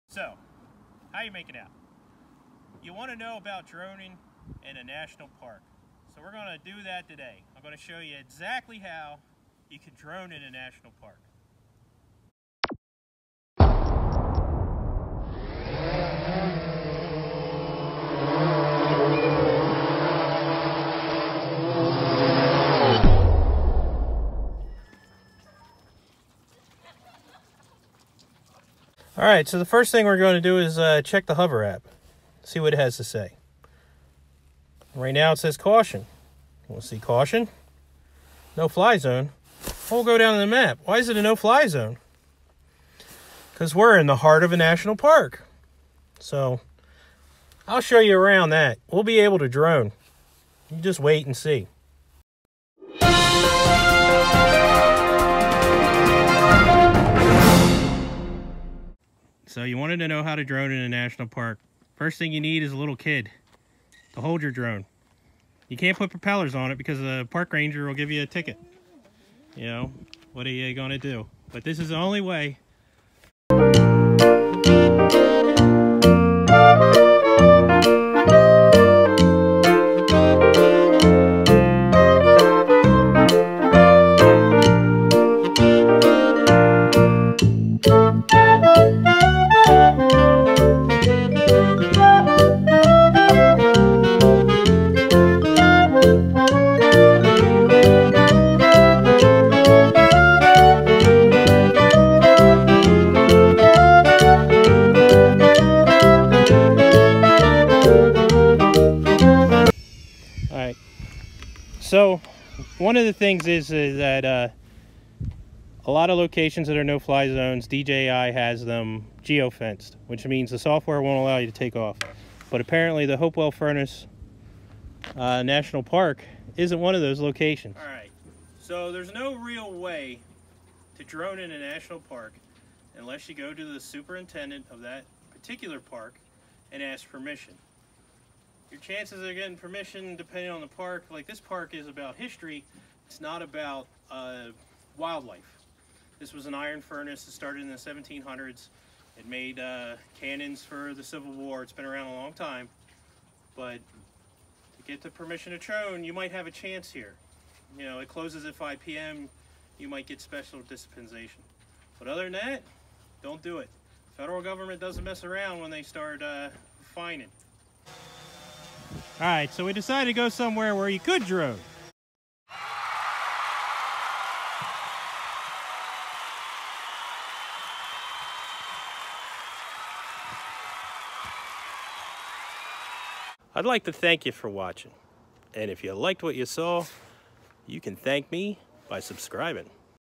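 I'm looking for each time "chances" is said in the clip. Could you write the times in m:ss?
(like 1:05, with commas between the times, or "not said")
2:18, 2:36.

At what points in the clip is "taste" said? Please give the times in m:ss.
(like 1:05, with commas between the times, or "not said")
not said.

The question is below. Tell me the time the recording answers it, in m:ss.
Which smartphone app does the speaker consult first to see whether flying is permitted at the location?
0:31.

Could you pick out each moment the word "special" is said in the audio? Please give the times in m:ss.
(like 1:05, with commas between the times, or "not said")
2:40.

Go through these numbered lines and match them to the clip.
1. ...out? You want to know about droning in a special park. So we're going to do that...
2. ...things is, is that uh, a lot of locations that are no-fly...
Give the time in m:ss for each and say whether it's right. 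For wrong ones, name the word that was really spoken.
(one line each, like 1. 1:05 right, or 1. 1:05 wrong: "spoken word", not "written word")
1. 0:01 wrong: "national", not "special"
2. 1:53 right.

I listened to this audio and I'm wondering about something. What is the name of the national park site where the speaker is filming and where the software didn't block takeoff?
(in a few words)
Hopewell Furnace.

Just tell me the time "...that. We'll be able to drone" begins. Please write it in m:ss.
0:48.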